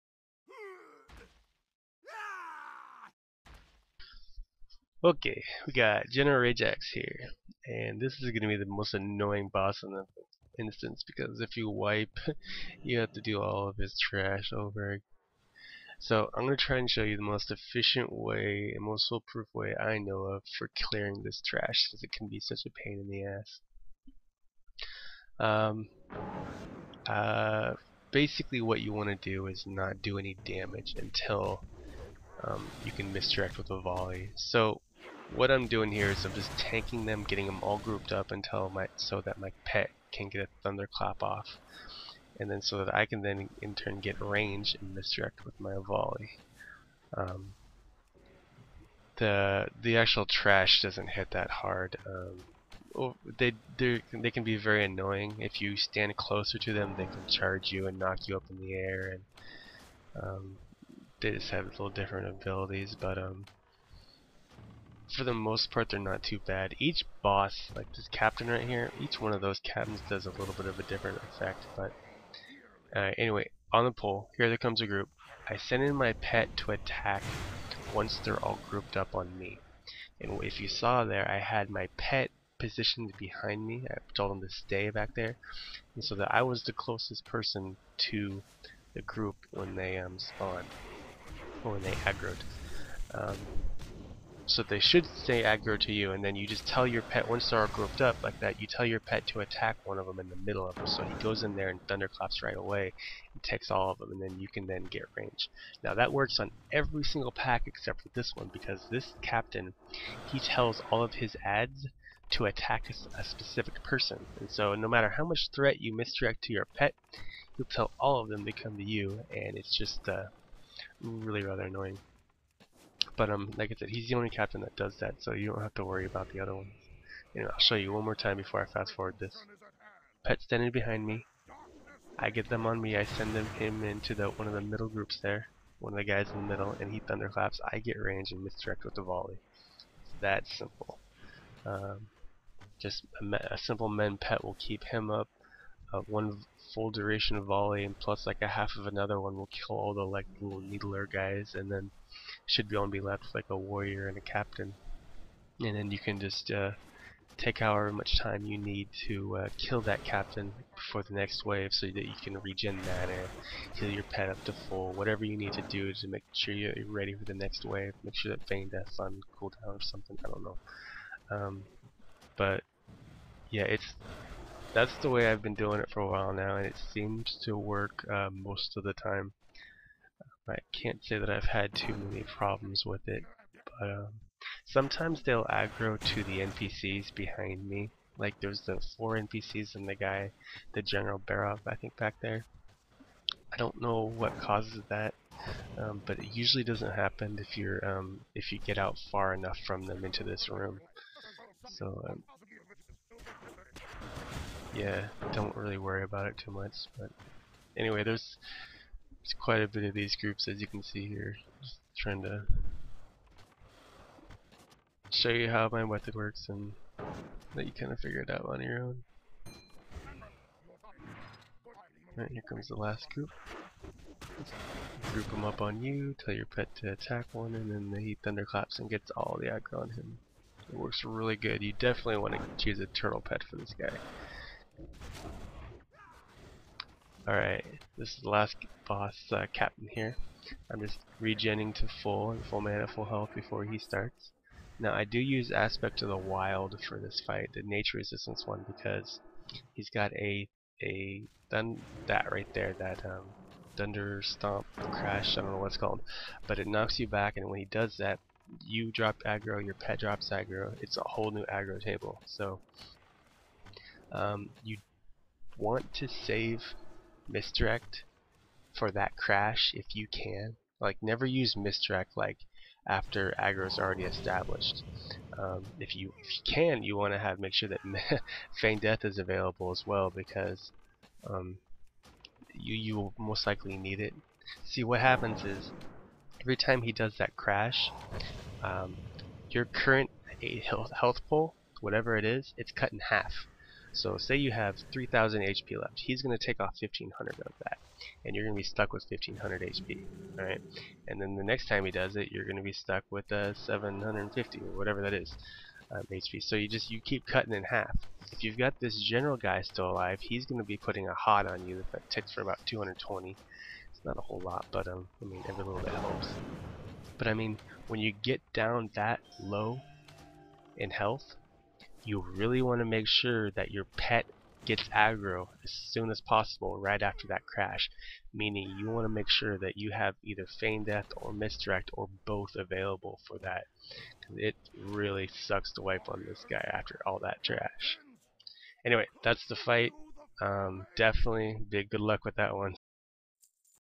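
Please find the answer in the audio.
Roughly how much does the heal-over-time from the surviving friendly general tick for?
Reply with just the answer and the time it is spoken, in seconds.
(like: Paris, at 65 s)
About 220, at 312 s.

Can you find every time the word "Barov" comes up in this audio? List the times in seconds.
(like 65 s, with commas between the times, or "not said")
191 s.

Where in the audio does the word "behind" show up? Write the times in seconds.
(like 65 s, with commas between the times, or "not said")
83 s, 130 s, 187 s.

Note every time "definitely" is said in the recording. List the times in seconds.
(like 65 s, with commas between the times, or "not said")
231 s, 340 s.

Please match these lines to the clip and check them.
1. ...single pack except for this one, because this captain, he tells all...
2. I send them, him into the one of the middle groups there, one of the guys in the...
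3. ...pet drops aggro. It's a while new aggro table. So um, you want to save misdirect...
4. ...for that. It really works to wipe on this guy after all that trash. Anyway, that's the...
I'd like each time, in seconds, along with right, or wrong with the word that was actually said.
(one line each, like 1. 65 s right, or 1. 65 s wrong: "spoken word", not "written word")
1. 107 s right
2. 132 s right
3. 259 s wrong: "whole", not "while"
4. 333 s wrong: "sucks", not "works".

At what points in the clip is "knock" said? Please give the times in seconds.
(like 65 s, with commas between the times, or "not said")
57 s, 256 s.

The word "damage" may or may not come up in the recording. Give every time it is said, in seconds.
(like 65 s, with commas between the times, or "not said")
30 s.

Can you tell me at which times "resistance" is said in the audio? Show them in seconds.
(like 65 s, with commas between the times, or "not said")
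247 s.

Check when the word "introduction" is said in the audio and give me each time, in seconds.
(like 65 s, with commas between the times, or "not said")
not said.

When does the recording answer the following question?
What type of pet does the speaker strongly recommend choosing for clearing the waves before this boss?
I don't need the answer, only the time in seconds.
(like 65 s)
232 s.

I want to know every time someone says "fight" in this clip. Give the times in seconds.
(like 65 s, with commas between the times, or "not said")
247 s, 339 s.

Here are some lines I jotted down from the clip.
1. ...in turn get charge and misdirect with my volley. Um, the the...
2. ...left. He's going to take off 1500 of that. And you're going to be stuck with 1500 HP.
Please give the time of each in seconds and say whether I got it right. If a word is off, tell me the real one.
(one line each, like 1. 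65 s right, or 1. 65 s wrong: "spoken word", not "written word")
1. 43 s wrong: "range", not "charge"
2. 295 s right.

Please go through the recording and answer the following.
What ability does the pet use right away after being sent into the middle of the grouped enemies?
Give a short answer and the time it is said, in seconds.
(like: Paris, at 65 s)
Thunderclap, at 101 s.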